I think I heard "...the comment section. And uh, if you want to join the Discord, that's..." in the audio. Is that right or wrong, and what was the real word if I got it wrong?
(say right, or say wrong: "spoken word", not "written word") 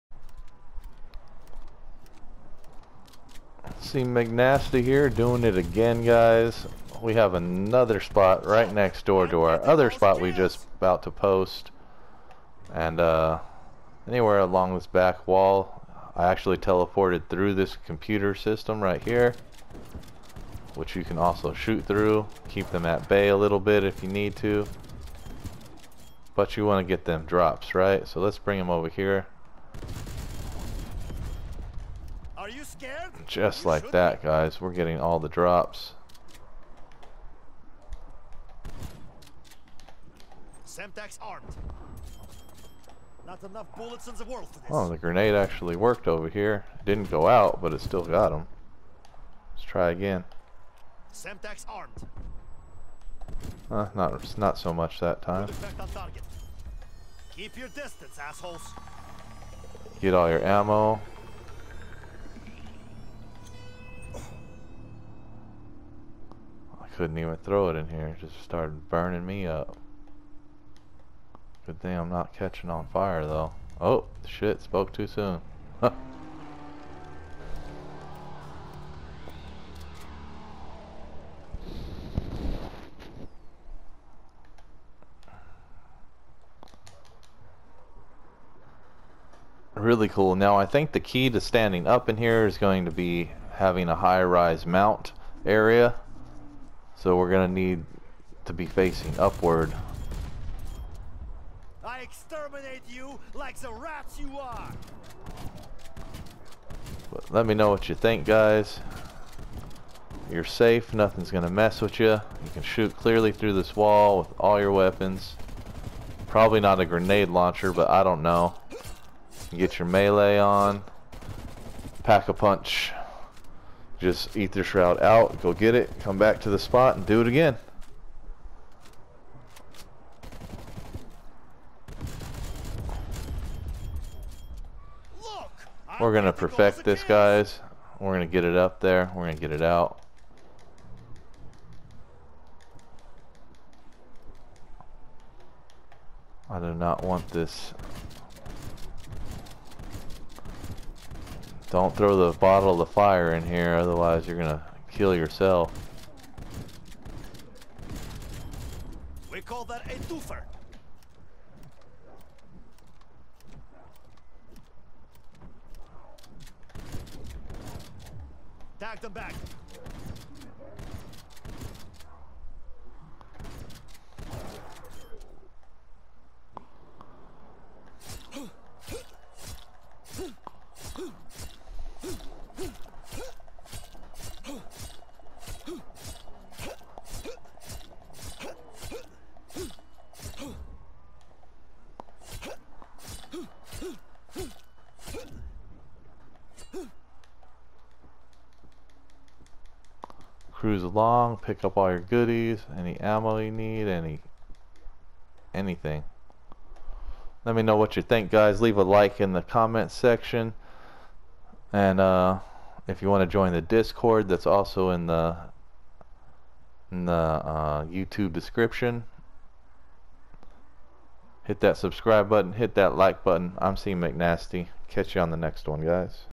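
right.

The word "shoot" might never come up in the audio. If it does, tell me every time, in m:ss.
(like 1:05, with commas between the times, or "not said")
0:21, 1:52.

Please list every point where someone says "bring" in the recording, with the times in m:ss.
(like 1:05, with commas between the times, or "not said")
0:28.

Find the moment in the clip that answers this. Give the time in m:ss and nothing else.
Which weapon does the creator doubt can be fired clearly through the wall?
1:56.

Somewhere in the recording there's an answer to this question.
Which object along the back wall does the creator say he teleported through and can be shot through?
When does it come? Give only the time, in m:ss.
0:17.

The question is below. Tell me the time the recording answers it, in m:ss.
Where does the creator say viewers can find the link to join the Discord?
3:37.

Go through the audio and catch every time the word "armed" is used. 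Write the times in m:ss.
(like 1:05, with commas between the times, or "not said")
0:41, 0:51.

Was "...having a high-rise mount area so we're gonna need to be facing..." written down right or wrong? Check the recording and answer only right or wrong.
right.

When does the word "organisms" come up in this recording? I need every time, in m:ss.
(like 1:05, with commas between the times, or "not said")
not said.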